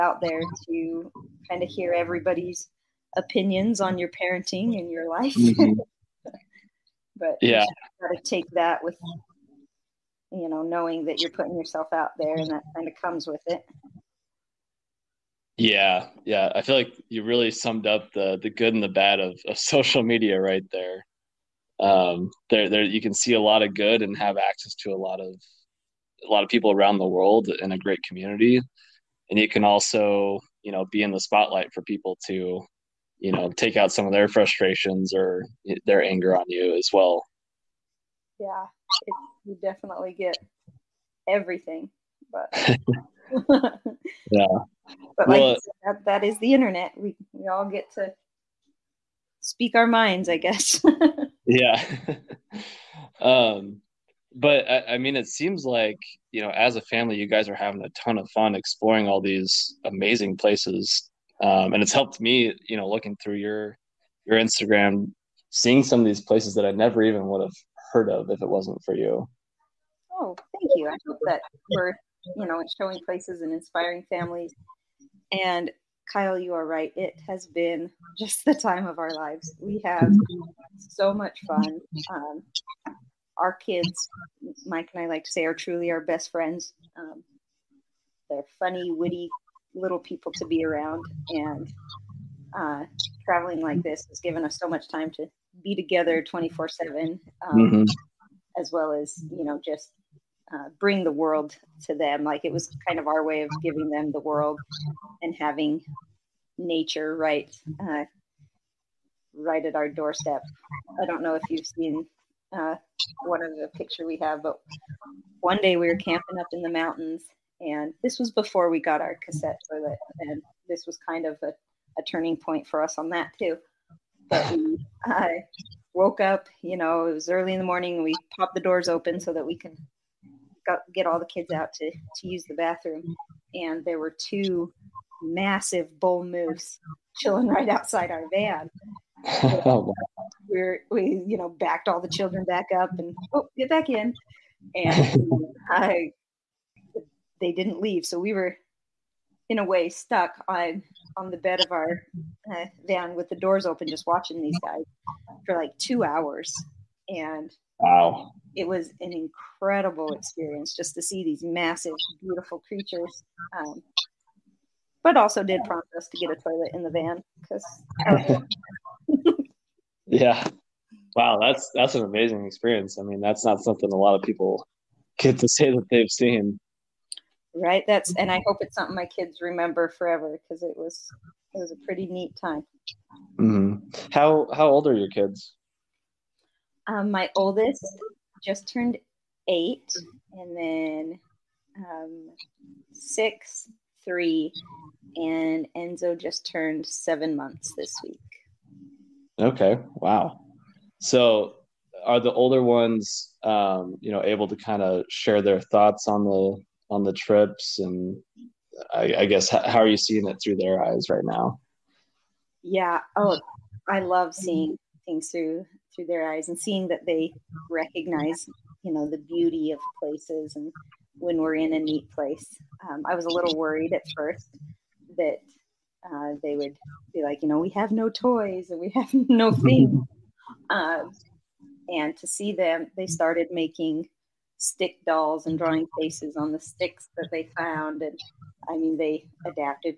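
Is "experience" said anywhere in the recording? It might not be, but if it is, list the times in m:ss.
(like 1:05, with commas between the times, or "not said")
2:40, 2:52.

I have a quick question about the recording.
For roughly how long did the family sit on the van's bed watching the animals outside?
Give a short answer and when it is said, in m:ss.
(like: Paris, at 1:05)
2 hours, at 2:35.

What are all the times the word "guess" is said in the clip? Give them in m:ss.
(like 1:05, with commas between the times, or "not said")
0:50, 3:29.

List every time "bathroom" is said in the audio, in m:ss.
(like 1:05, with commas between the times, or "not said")
2:12.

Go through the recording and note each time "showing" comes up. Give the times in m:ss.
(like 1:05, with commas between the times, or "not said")
1:12.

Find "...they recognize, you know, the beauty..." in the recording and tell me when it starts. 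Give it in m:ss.
3:37.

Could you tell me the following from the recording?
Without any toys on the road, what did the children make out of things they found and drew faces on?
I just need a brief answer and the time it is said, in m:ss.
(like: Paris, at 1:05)
stick dolls, at 3:54.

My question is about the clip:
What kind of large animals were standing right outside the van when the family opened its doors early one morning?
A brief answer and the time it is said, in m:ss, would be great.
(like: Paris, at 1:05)
bull moose, at 2:15.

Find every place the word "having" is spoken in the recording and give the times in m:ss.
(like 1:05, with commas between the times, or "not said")
0:57, 1:45.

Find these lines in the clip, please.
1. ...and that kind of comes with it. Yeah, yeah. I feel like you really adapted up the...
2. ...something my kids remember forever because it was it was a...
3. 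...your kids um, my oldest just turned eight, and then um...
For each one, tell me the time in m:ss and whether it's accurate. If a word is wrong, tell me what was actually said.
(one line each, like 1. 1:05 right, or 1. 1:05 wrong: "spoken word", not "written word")
1. 0:12 wrong: "summed", not "adapted"
2. 2:58 right
3. 3:04 right.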